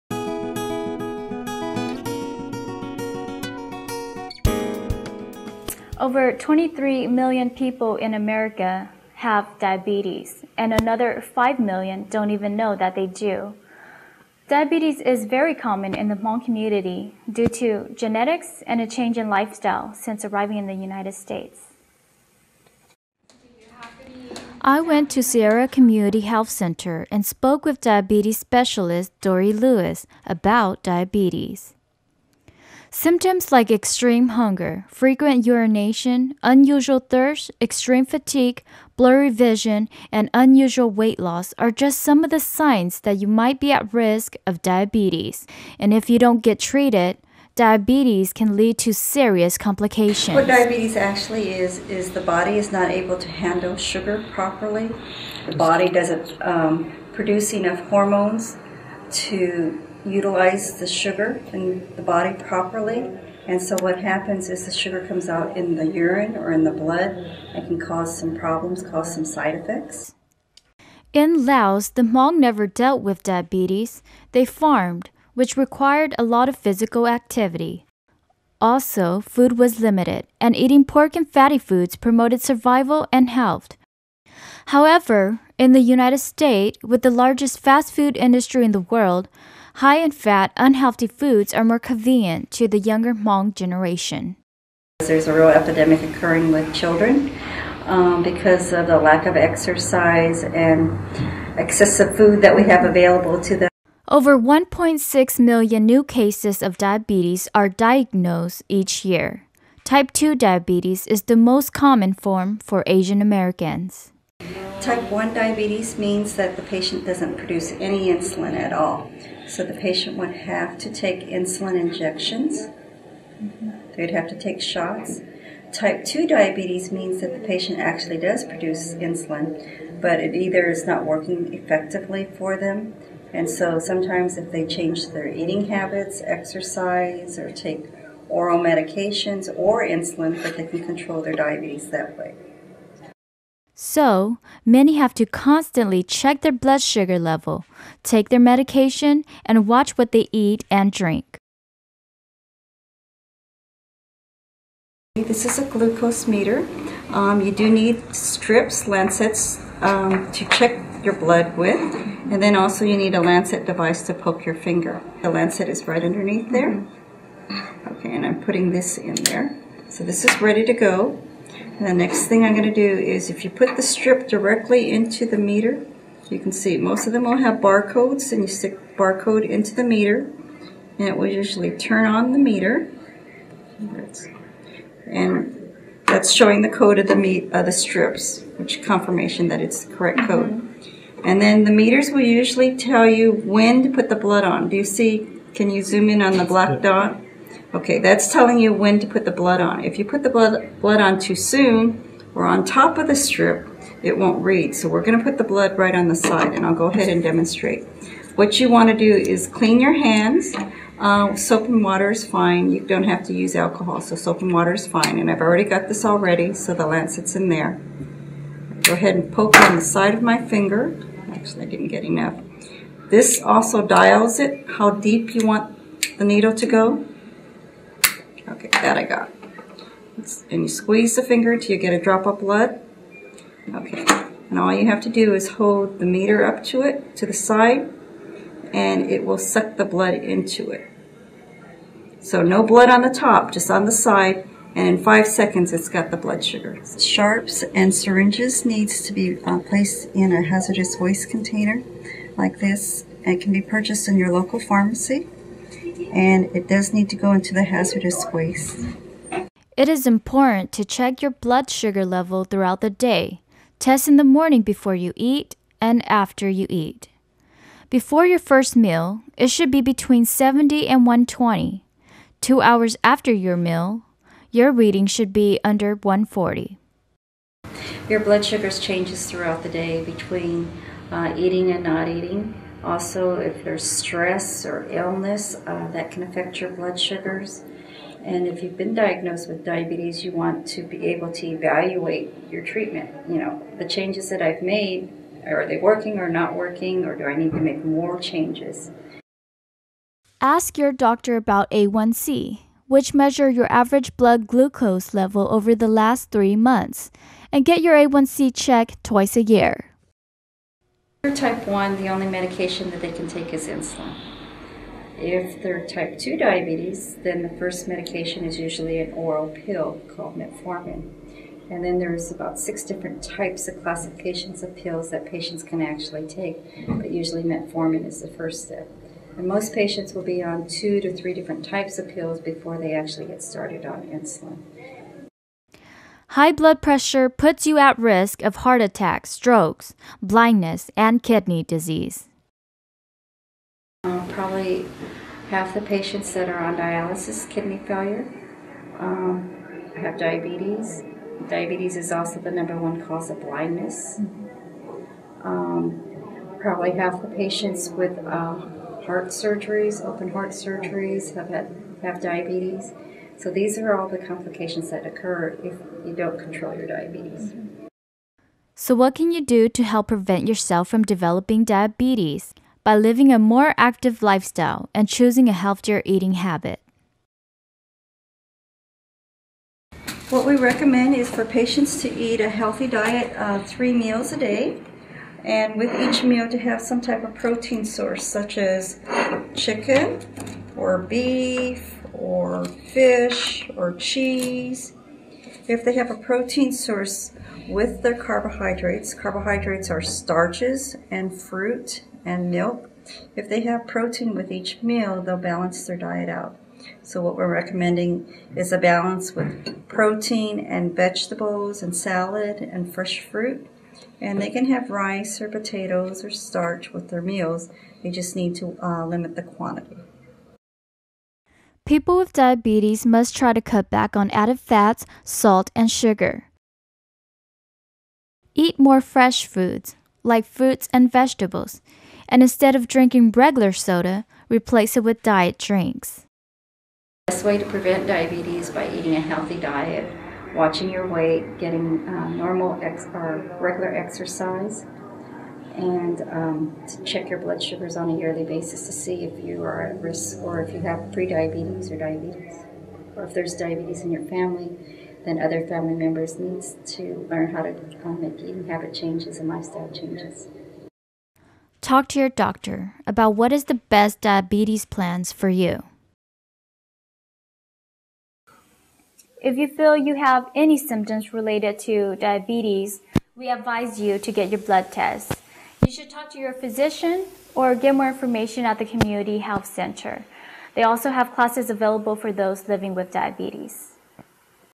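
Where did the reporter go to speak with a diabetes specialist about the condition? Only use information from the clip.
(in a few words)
Sierra Community Health Center.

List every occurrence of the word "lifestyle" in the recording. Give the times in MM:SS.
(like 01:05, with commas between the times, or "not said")
00:19, 06:14, 07:39.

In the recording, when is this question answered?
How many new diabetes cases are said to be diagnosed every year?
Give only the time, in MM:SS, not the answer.
01:44.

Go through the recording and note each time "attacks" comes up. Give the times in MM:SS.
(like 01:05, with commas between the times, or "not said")
05:38.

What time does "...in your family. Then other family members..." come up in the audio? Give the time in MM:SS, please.
07:34.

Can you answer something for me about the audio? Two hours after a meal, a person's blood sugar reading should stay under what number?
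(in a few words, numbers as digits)
140.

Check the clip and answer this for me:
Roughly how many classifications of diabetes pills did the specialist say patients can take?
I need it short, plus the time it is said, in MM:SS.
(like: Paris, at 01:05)
6, at 05:22.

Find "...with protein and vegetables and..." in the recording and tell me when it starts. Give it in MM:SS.
06:49.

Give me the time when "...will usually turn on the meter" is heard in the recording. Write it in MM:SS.
03:01.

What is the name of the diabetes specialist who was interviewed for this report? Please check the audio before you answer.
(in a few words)
Dory Lewis.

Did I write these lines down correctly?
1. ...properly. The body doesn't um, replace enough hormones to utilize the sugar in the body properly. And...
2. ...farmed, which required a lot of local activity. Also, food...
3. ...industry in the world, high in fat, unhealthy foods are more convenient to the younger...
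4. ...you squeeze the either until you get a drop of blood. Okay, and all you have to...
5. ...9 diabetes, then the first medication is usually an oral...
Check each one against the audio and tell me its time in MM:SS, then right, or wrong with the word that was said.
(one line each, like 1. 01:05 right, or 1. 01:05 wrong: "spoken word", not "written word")
1. 00:54 wrong: "produce", not "replace"
2. 01:14 wrong: "physical", not "local"
3. 01:28 right
4. 03:50 wrong: "finger", not "either"
5. 05:16 wrong: "2", not "9".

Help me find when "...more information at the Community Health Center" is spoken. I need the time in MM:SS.
07:57.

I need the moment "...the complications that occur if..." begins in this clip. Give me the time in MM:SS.
06:04.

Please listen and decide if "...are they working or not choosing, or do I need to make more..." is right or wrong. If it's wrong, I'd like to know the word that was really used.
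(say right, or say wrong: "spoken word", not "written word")
wrong: "working", not "choosing".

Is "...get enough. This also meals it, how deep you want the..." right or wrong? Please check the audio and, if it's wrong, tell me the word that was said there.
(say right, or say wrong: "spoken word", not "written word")
wrong: "dials", not "meals".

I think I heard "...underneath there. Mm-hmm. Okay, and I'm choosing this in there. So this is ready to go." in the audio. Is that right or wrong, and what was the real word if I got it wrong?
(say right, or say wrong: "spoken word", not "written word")
wrong: "putting", not "choosing".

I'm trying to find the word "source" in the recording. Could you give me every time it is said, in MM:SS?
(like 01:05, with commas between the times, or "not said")
06:27, 06:36.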